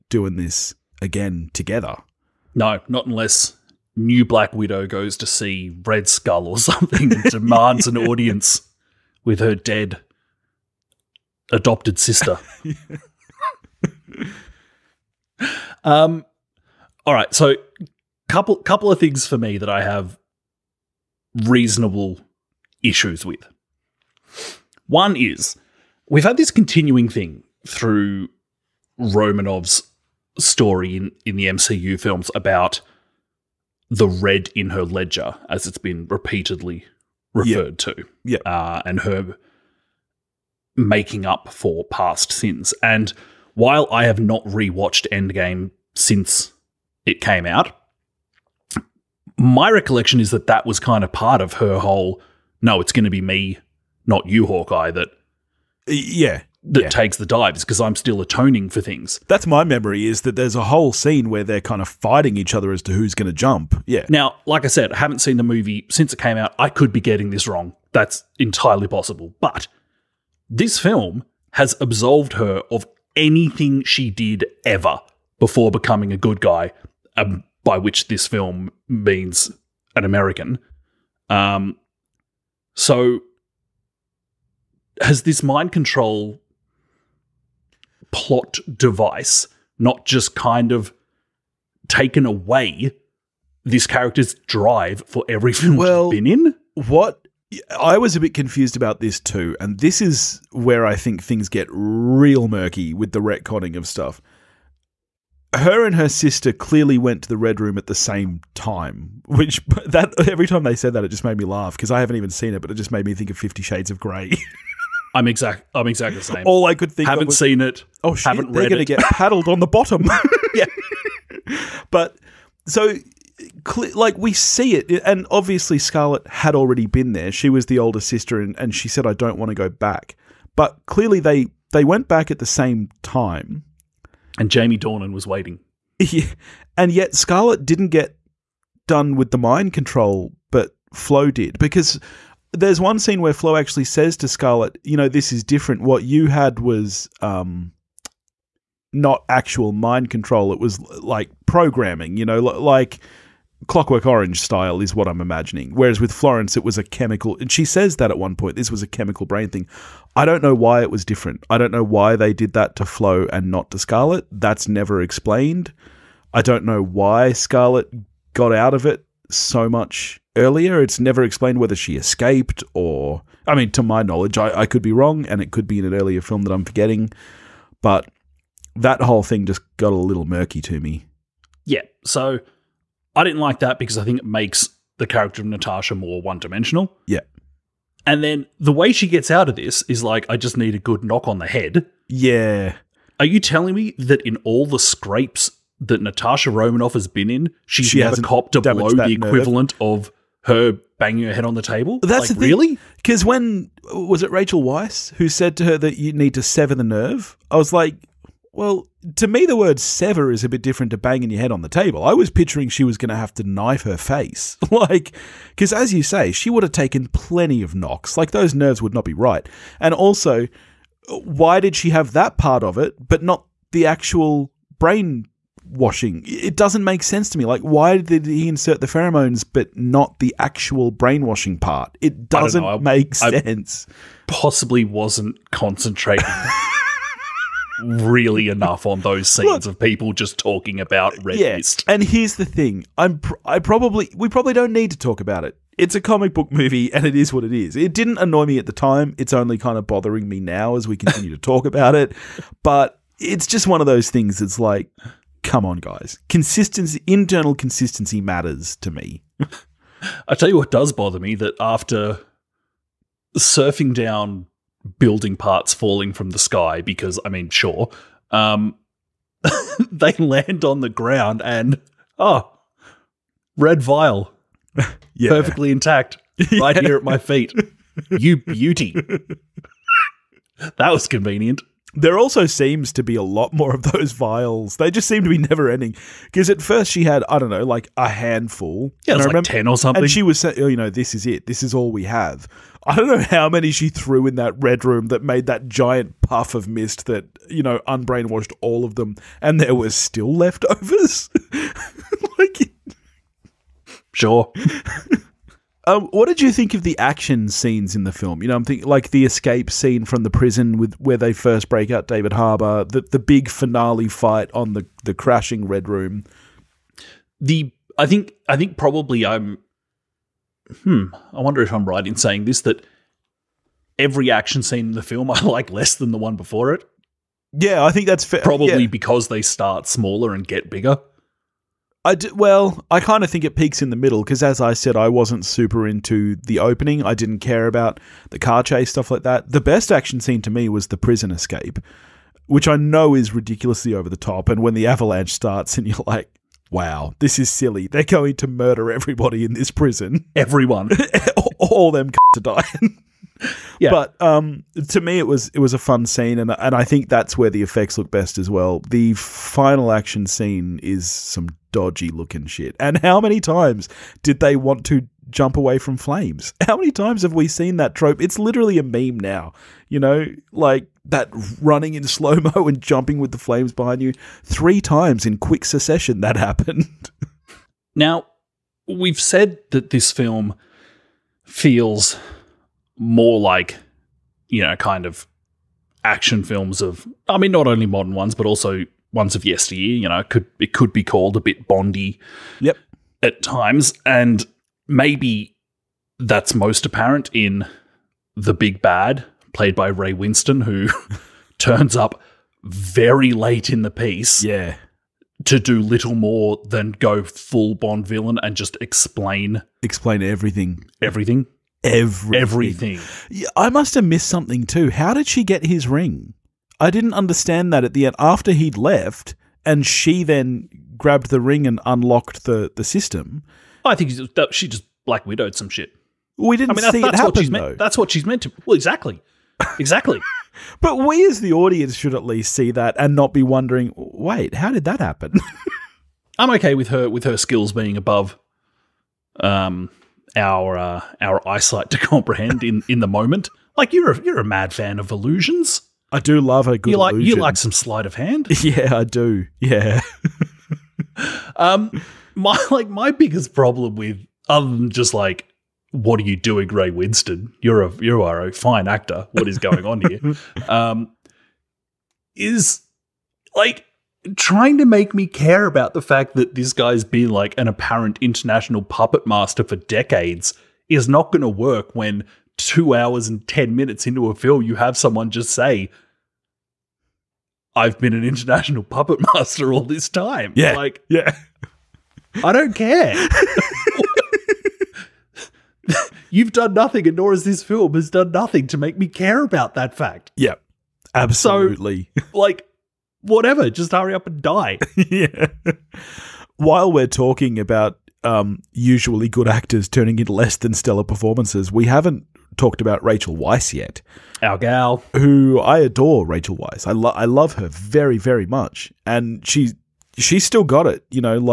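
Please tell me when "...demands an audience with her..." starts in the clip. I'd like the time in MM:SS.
00:07.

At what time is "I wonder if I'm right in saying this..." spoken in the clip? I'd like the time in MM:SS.
05:21.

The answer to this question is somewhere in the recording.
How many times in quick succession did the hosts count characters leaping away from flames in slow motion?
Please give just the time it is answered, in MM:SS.
06:14.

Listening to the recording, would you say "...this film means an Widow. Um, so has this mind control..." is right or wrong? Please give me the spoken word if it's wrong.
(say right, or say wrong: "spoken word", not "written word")
wrong: "American", not "Widow".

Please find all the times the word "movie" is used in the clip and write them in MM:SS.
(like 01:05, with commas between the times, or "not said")
01:05, 04:06.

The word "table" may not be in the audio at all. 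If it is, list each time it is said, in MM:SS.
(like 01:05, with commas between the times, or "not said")
03:21, 03:31.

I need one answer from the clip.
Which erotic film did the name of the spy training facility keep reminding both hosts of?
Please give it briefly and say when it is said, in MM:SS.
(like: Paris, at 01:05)
Fifty Shades of Grey, at 01:53.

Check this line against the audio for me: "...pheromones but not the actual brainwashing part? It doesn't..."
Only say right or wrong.
right.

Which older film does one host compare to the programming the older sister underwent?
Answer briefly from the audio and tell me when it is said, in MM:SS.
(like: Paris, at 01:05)
Clockwork Orange, at 02:33.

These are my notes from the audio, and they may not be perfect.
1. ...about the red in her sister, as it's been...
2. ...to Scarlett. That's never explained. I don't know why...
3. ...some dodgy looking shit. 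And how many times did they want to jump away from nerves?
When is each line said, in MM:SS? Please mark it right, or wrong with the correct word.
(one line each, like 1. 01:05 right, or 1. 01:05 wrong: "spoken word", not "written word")
1. 00:32 wrong: "ledger", not "sister"
2. 02:43 right
3. 06:01 wrong: "flames", not "nerves".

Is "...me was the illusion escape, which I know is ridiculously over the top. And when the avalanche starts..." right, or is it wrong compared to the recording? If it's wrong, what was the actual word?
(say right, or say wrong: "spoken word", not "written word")
wrong: "prison", not "illusion".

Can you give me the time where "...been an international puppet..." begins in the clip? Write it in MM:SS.
07:57.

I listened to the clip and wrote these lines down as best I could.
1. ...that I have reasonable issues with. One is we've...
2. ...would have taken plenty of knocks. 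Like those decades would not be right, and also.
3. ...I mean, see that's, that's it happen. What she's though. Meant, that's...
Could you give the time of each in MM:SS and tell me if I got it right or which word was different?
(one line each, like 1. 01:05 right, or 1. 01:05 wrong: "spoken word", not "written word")
1. 00:19 right
2. 03:36 wrong: "nerves", not "decades"
3. 07:06 right.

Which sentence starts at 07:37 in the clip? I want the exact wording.
You're a you are a fine actor.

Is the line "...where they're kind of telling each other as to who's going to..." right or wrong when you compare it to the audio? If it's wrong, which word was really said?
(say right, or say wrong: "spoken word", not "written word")
wrong: "fighting", not "telling".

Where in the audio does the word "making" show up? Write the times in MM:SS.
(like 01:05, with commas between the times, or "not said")
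00:40.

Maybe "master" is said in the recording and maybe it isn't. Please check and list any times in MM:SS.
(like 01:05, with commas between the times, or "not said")
07:49, 07:59.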